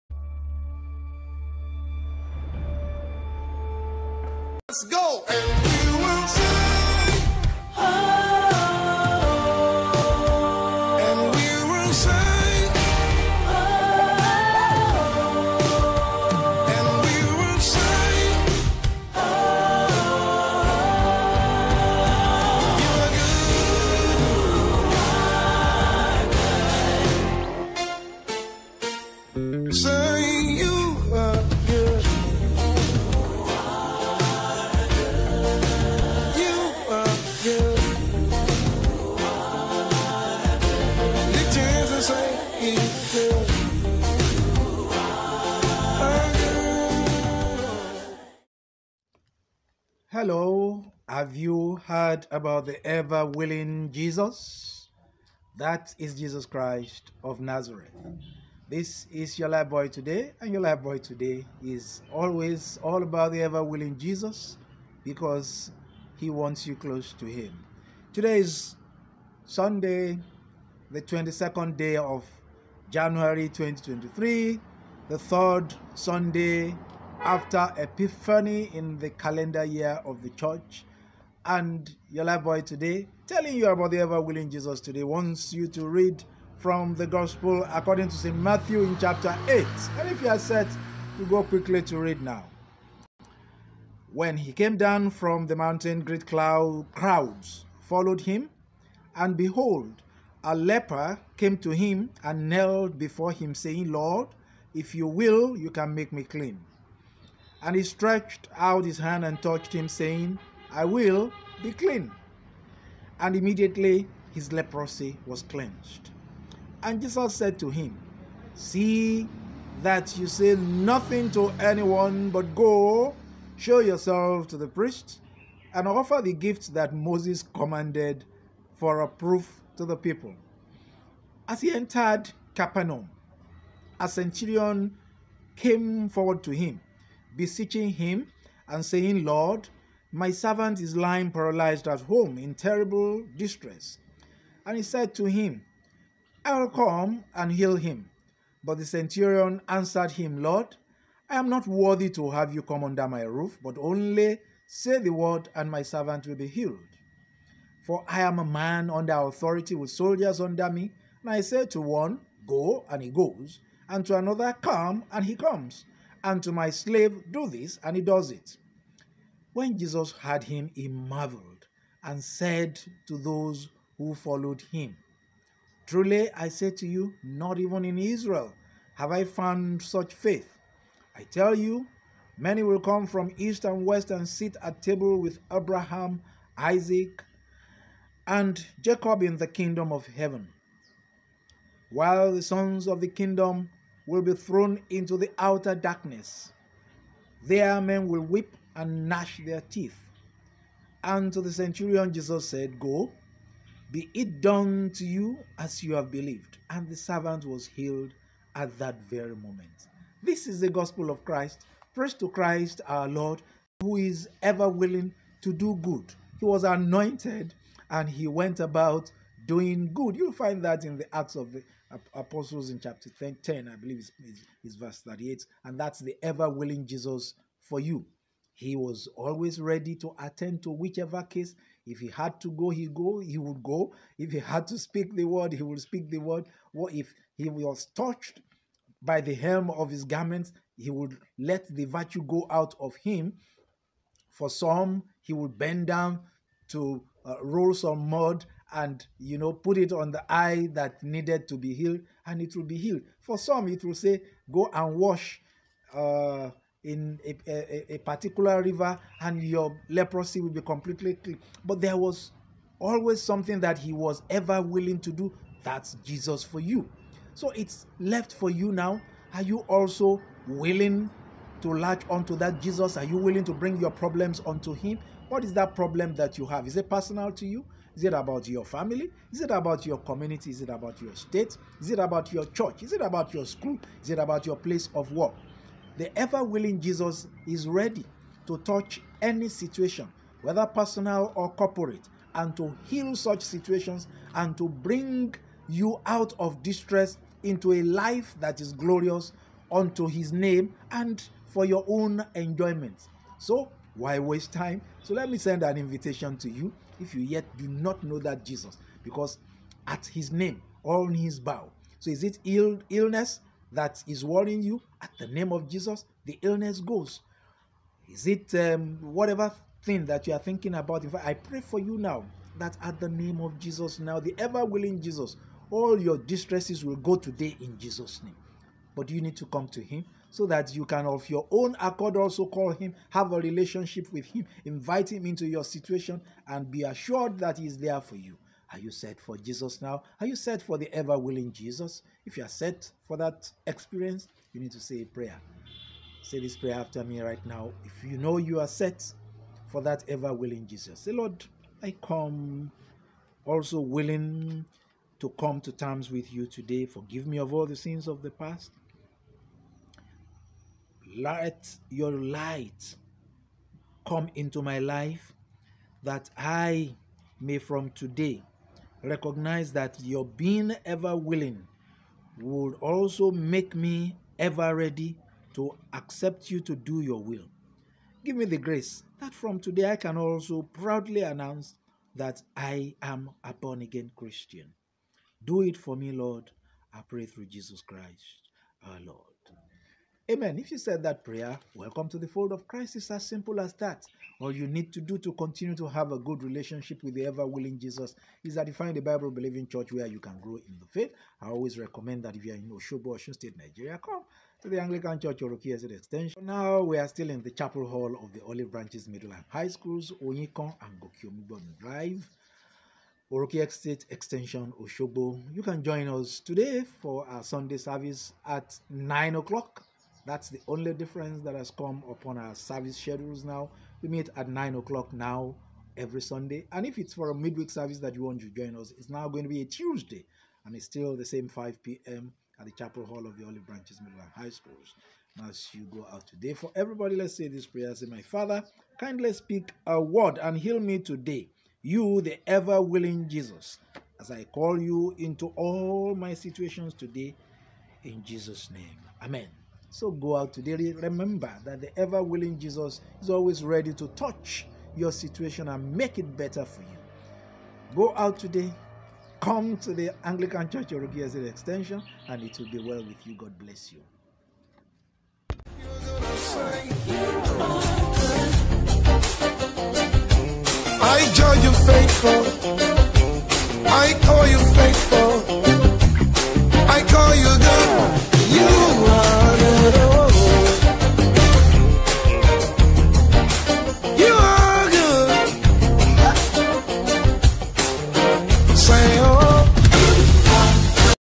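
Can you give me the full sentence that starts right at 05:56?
Forgive me of all the sins of the past.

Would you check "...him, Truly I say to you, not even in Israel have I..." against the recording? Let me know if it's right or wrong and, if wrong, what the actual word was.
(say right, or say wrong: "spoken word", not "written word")
right.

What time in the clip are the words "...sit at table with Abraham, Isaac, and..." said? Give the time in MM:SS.
03:04.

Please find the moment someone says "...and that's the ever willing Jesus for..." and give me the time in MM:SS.
03:45.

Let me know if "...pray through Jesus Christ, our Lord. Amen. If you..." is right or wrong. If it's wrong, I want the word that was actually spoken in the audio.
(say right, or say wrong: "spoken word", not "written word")
right.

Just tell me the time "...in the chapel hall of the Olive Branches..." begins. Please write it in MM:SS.
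06:47.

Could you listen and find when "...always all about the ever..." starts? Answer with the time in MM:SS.
01:02.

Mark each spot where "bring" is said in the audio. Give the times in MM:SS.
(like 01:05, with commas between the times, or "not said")
04:33, 04:54.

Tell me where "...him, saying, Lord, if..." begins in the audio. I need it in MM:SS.
01:43.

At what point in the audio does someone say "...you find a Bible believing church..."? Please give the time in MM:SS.
06:38.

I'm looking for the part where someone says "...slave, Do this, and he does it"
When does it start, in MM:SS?
02:46.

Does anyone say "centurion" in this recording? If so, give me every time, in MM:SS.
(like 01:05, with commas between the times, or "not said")
02:14, 02:28, 03:21.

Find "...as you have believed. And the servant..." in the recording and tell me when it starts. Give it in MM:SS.
03:25.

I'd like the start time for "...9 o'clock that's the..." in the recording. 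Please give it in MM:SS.
06:58.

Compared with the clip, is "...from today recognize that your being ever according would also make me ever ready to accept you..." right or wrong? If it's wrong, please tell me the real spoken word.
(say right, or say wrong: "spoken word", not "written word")
wrong: "willing", not "according".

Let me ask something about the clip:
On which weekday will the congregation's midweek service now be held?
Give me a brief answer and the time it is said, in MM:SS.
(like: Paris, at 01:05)
Tuesday, at 07:09.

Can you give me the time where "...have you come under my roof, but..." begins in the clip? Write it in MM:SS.
02:32.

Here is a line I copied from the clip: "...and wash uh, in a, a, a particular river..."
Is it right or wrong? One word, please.
right.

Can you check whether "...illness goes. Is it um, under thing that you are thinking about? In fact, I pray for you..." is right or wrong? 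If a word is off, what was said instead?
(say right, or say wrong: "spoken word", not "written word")
wrong: "whatever", not "under".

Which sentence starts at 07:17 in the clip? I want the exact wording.
Say, My Father, kindly speak a word and heal me today.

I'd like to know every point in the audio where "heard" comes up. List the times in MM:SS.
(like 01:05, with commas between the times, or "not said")
00:51, 02:50.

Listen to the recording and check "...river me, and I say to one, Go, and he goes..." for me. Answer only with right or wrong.
wrong.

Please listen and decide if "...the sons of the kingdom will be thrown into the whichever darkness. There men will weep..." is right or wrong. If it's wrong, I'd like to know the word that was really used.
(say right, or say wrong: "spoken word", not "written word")
wrong: "outer", not "whichever".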